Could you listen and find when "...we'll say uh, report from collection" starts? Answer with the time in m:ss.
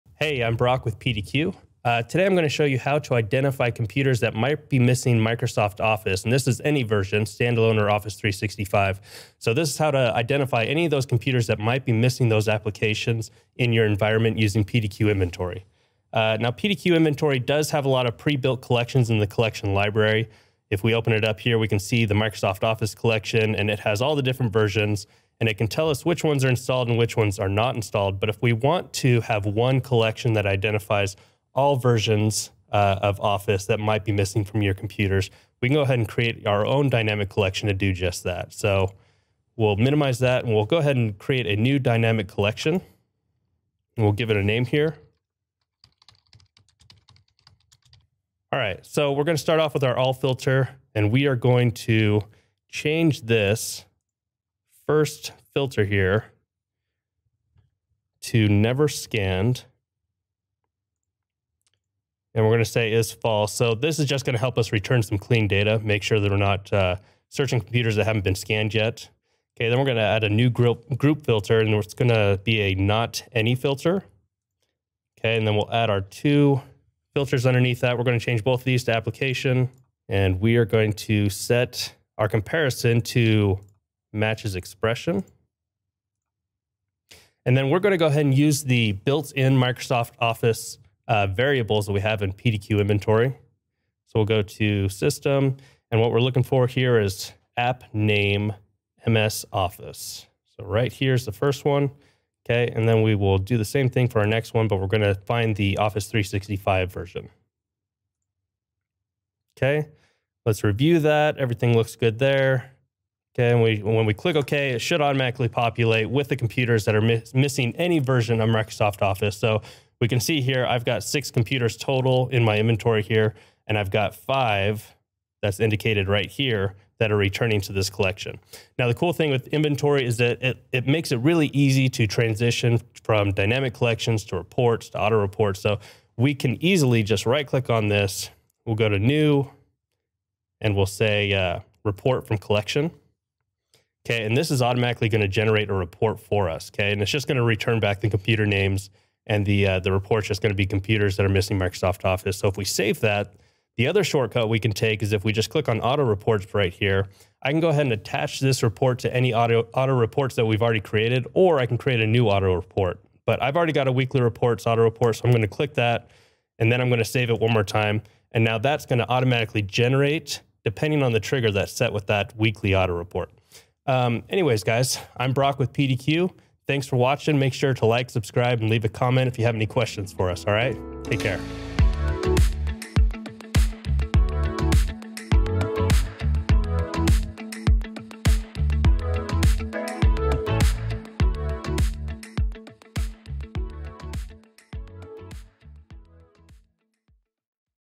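2:20.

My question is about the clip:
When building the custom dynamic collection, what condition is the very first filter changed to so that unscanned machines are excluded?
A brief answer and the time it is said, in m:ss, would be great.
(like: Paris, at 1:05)
Never scanned, at 0:58.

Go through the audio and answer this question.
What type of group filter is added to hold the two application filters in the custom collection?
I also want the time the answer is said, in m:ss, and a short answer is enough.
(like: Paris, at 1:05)
Not any, at 1:12.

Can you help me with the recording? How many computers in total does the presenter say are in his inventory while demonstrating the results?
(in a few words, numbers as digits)
6.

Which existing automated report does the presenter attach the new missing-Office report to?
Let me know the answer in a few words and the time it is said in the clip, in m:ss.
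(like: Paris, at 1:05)
Weekly reports, at 2:43.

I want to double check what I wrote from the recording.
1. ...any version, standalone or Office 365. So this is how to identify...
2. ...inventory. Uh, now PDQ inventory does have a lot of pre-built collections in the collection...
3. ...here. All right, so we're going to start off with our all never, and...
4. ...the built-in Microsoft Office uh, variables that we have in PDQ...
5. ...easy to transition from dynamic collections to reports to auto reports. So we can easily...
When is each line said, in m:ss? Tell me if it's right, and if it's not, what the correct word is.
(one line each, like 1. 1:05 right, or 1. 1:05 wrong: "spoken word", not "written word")
1. 0:06 right
2. 0:15 right
3. 0:44 wrong: "filter", not "never"
4. 1:28 right
5. 2:11 right.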